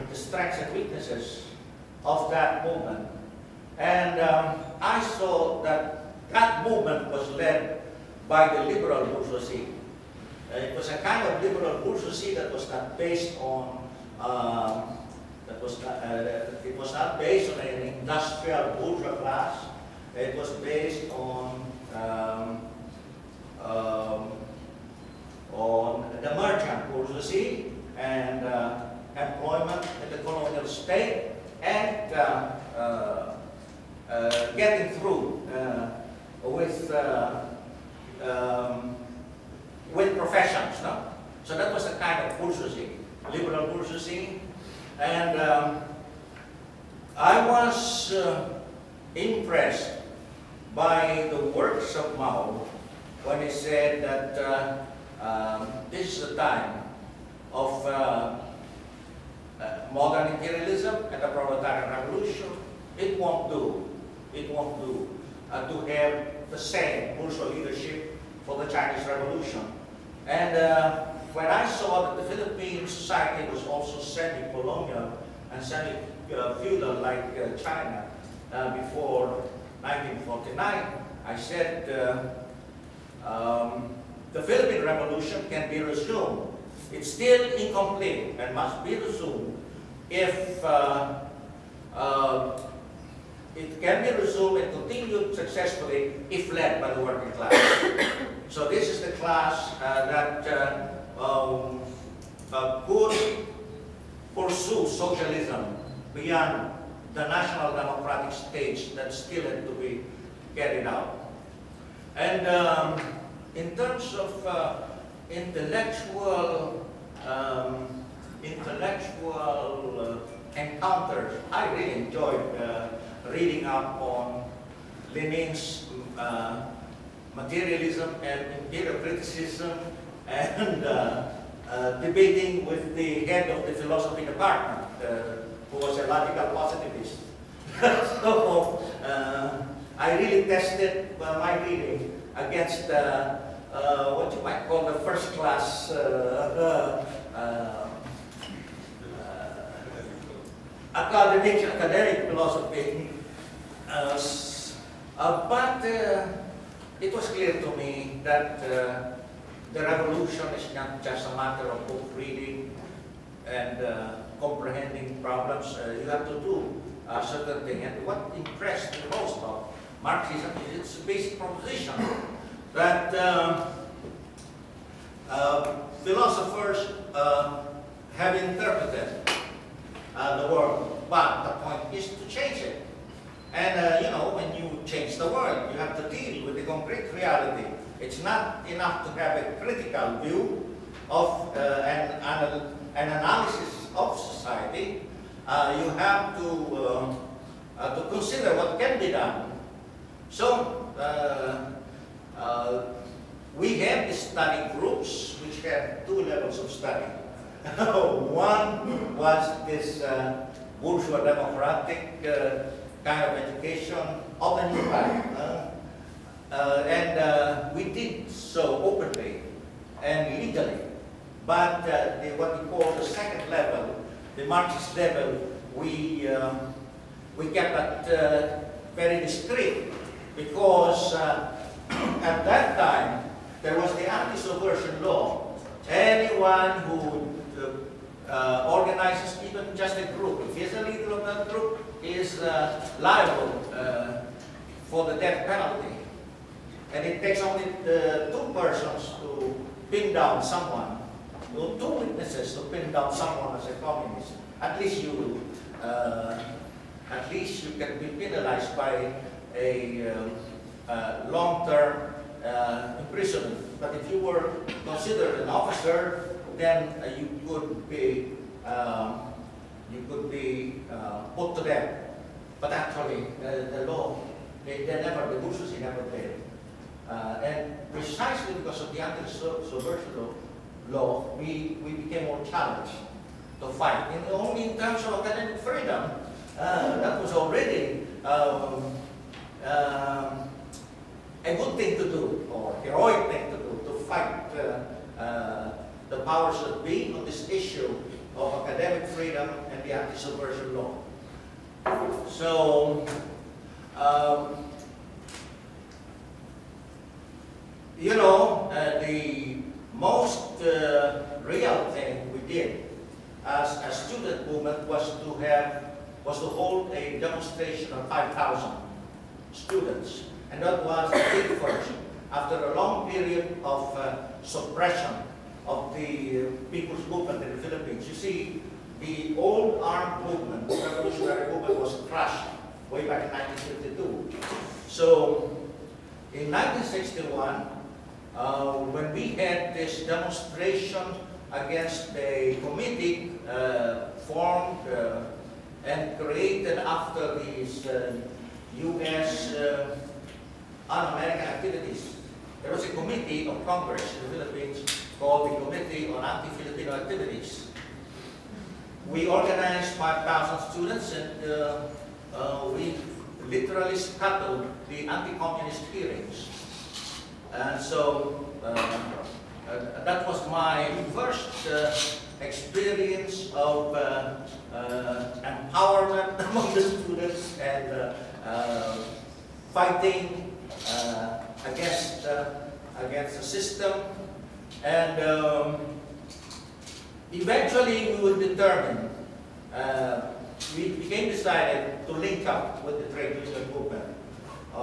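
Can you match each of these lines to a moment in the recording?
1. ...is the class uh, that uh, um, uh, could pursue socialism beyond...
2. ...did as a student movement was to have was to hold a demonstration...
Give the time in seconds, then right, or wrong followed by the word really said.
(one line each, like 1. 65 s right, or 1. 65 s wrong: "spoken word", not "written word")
1. 98 s right
2. 312 s right.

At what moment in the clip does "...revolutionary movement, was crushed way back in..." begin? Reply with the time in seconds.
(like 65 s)
330 s.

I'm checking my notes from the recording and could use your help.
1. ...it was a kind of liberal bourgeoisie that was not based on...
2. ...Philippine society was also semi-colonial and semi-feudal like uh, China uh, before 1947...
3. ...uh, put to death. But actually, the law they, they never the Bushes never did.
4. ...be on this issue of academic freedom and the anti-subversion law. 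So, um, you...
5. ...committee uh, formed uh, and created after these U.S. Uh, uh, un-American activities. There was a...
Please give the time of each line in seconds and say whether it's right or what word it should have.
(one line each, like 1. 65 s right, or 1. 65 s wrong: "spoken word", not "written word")
1. 10 s right
2. 72 s wrong: "1949", not "1947"
3. 270 s right
4. 296 s right
5. 342 s right.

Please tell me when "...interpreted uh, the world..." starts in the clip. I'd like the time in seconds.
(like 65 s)
178 s.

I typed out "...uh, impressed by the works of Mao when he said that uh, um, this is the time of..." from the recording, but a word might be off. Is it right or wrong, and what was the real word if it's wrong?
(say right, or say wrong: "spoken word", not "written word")
right.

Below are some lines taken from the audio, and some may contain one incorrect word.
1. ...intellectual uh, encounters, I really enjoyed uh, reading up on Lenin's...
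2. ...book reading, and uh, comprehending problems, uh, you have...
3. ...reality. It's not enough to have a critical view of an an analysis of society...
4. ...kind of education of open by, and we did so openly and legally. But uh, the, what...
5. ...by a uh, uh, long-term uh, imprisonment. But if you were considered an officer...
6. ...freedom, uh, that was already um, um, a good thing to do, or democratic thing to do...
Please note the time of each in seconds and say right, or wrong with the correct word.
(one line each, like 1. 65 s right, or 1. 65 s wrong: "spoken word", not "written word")
1. 118 s right
2. 161 s right
3. 187 s right
4. 213 s right
5. 258 s right
6. 285 s wrong: "heroic", not "democratic".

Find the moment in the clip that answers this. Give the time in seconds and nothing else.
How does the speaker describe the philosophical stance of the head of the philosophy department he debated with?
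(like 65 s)
136 s.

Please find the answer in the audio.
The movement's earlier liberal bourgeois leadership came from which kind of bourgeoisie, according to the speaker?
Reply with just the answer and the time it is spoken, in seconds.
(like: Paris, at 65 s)
merchant bourgeoisie, at 26 s.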